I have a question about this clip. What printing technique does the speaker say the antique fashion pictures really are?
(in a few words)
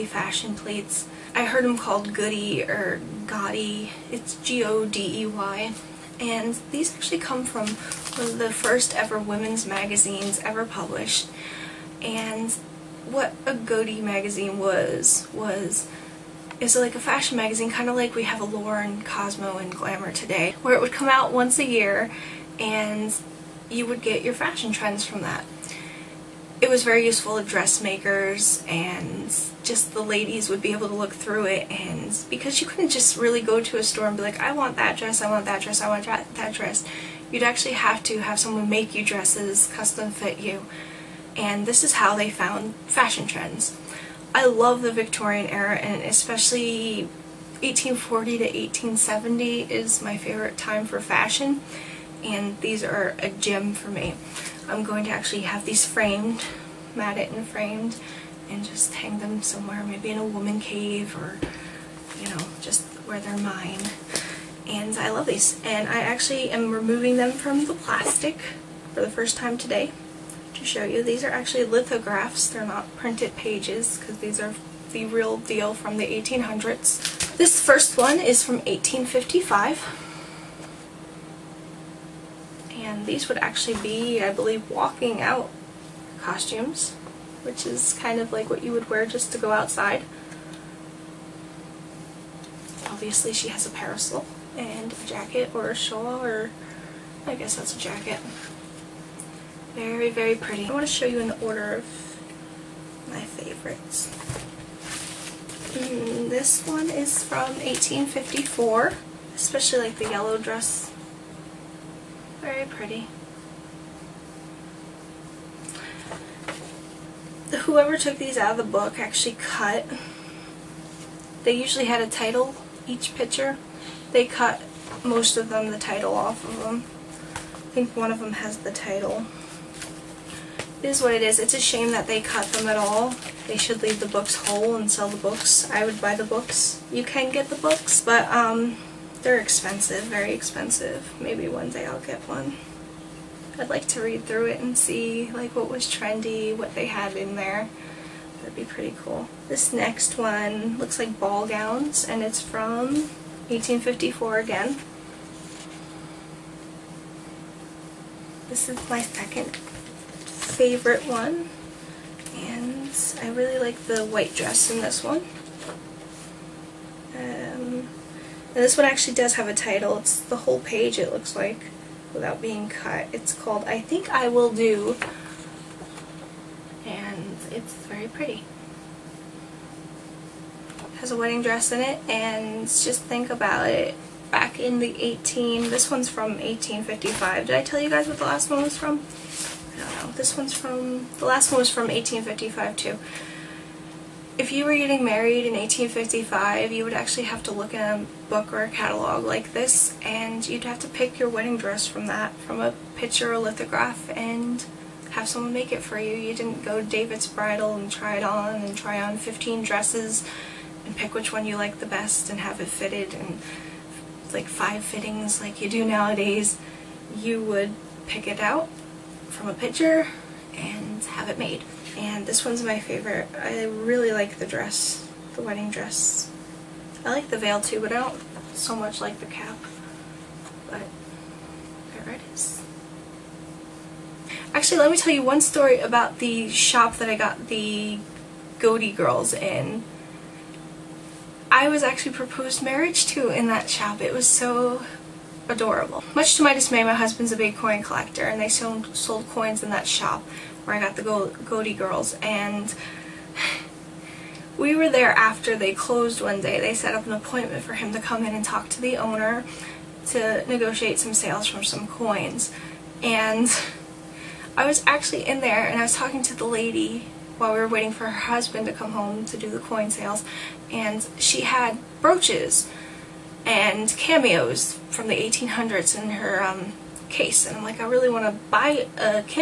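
Lithographs.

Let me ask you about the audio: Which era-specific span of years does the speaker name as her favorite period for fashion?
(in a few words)
1840 to 1870.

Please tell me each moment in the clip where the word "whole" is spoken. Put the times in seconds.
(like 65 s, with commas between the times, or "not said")
134 s, 170 s.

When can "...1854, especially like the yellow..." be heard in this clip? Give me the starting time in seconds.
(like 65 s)
107 s.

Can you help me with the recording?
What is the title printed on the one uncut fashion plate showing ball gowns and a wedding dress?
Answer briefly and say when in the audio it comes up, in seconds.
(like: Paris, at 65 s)
I Think I Will Do, at 173 s.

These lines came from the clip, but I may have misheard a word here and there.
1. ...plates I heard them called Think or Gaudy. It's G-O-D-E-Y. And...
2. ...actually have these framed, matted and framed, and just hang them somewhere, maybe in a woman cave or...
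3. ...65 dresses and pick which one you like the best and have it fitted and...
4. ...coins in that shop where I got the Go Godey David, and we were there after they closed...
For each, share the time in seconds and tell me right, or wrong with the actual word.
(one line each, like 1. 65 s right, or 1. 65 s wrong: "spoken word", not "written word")
1. 0 s wrong: "Goody", not "Think"
2. 55 s right
3. 209 s wrong: "15", not "65"
4. 249 s wrong: "Girls", not "David".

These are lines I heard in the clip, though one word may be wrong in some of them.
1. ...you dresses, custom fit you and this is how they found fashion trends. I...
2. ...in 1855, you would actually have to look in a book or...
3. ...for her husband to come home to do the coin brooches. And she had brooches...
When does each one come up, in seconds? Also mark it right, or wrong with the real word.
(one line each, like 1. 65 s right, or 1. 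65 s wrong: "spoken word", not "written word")
1. 38 s right
2. 195 s right
3. 267 s wrong: "sales", not "brooches".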